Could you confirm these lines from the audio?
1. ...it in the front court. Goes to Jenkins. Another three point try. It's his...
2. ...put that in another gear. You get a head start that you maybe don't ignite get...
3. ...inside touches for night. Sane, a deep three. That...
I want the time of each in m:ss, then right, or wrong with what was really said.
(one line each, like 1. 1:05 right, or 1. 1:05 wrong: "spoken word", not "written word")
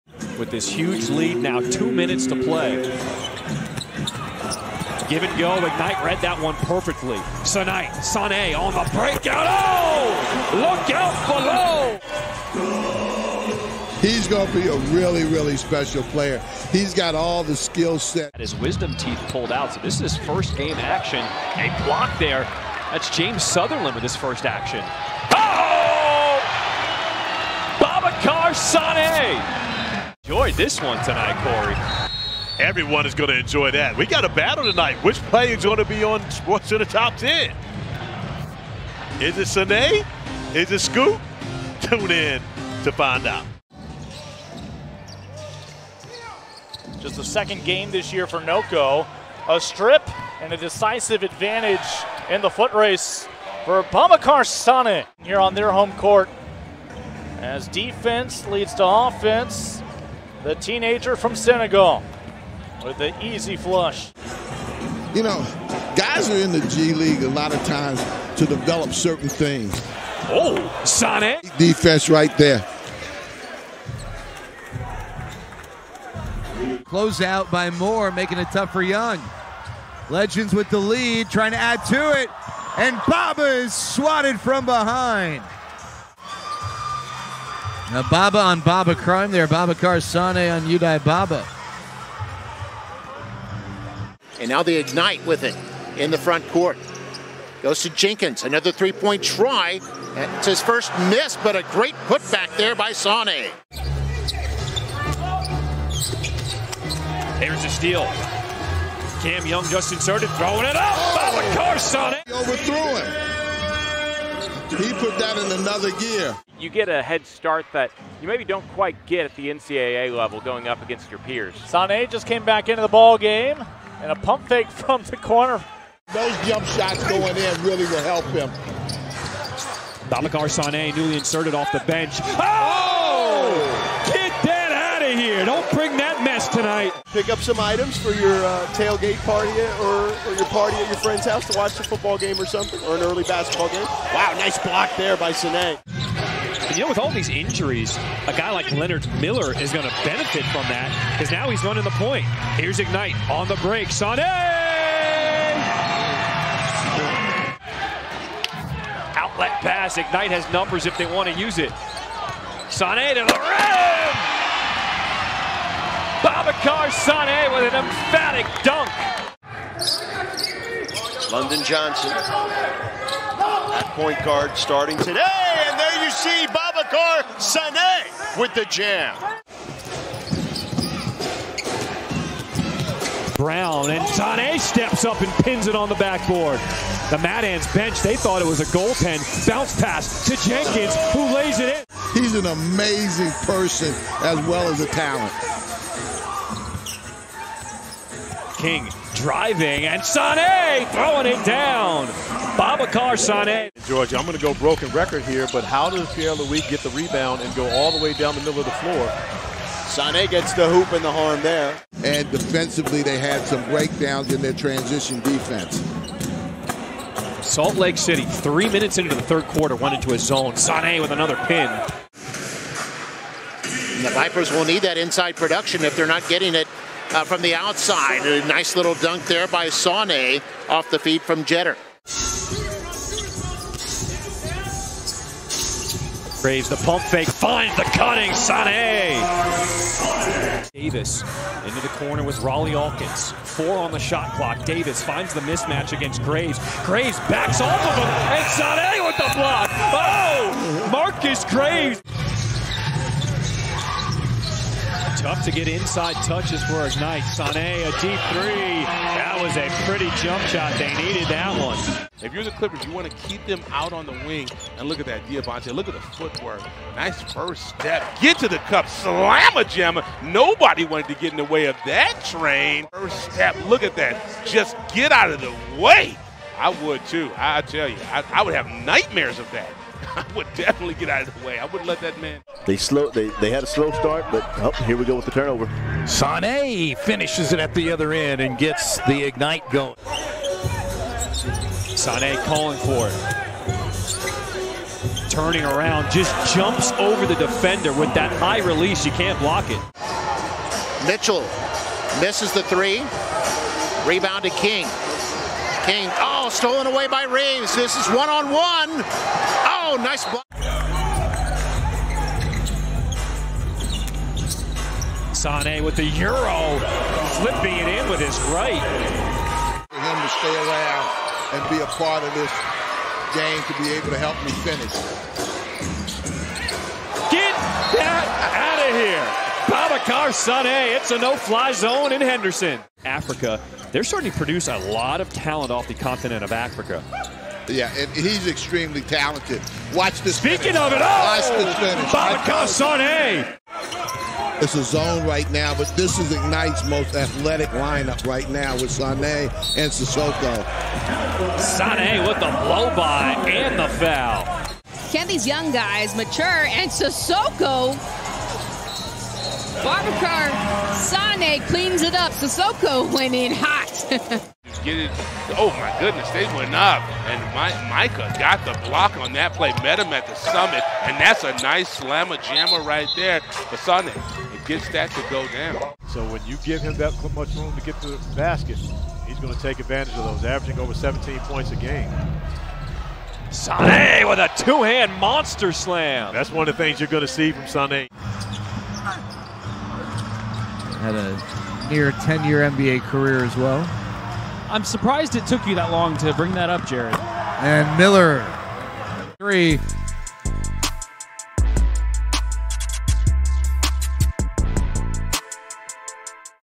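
1. 1:35 right
2. 1:54 wrong: "quite", not "ignite"
3. 4:15 right.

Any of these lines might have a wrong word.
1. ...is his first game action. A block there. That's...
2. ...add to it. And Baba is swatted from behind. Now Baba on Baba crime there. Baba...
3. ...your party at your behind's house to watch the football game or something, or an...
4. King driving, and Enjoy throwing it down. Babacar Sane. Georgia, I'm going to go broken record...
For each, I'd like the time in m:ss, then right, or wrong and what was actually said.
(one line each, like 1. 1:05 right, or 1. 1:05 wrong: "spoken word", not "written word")
1. 0:20 right
2. 1:21 right
3. 2:20 wrong: "friend", not "behind"
4. 3:18 wrong: "Sane", not "Enjoy".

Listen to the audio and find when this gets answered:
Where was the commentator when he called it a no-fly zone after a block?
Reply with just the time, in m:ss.
5:32.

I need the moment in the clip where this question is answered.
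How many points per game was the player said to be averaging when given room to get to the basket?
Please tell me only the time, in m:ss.
6:20.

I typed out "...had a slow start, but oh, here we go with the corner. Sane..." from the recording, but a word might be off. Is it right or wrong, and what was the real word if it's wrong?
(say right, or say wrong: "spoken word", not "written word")
wrong: "turnover", not "corner".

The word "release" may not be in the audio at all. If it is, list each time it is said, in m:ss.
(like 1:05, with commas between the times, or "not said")
4:58.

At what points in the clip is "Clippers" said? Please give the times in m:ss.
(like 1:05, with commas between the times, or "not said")
4:22.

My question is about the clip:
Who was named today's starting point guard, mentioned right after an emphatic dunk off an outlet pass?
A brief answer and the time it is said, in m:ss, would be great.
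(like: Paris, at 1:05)
London Johnson, at 2:51.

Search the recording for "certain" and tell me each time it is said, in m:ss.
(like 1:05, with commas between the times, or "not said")
1:08.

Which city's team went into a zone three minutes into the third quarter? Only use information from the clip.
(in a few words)
Salt Lake City.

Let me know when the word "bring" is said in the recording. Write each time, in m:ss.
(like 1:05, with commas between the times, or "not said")
2:15, 6:36.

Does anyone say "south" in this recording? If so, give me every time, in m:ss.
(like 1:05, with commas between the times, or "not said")
not said.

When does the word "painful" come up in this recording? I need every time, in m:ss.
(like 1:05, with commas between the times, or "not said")
not said.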